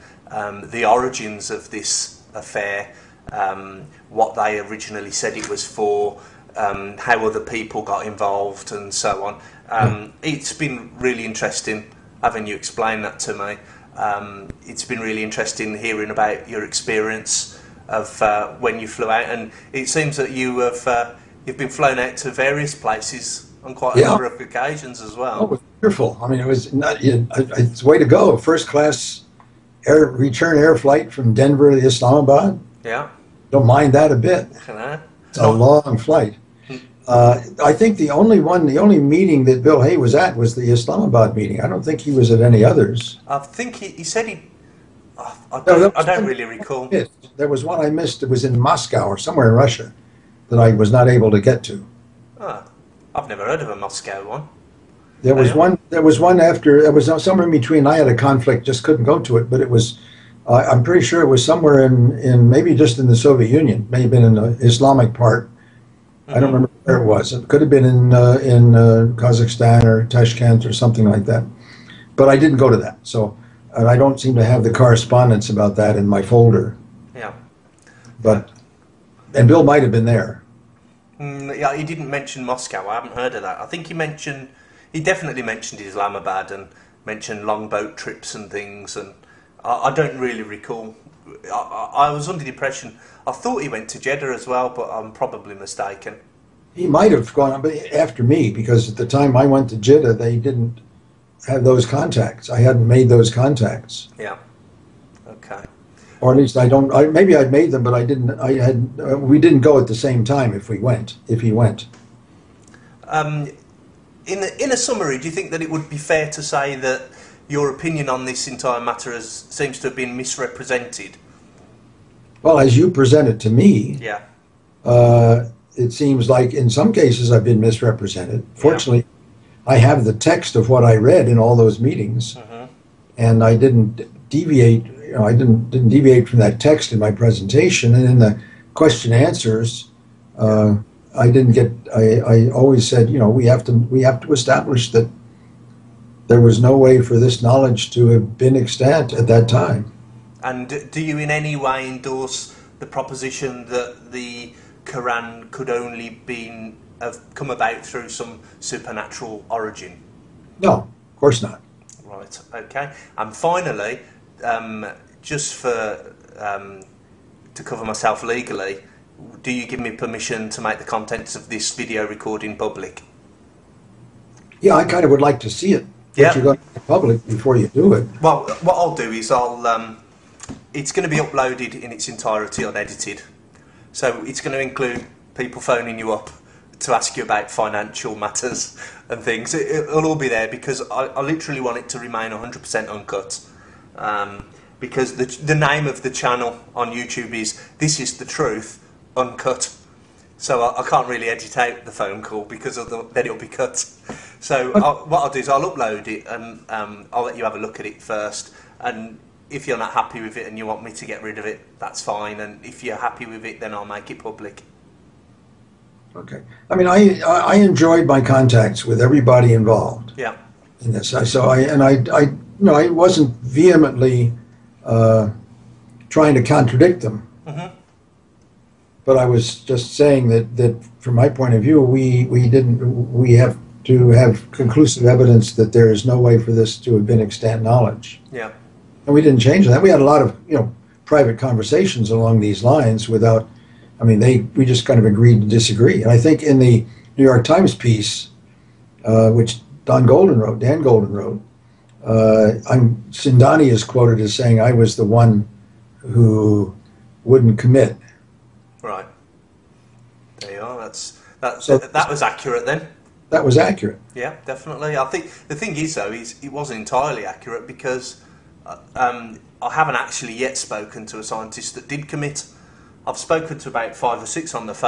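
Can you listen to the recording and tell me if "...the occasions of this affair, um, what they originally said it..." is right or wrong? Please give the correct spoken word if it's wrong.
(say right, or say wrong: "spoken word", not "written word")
wrong: "origins", not "occasions".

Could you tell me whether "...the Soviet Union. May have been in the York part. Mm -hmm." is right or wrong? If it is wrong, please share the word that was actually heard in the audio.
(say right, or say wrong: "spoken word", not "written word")
wrong: "Islamic", not "York".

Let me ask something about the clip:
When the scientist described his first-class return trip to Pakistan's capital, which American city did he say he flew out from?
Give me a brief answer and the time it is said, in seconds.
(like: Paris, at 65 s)
Denver, at 31 s.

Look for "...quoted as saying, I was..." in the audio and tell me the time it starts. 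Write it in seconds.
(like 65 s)
253 s.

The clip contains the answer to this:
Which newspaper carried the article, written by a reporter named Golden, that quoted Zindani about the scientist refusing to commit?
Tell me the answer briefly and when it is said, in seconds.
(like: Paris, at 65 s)
The New York Times, at 247 s.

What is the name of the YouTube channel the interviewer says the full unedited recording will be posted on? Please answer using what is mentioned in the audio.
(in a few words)
This is the Truth Uncut.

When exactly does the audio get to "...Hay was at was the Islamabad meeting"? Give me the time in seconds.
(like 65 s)
39 s.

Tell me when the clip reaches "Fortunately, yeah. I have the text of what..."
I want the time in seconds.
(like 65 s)
128 s.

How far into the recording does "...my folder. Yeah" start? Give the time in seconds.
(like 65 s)
76 s.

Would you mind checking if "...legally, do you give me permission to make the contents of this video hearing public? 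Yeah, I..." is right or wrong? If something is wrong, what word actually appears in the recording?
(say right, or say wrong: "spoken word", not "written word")
wrong: "recording", not "hearing".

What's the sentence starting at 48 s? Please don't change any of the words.
It was in Moscow or somewhere in Russia that I was not able to get to.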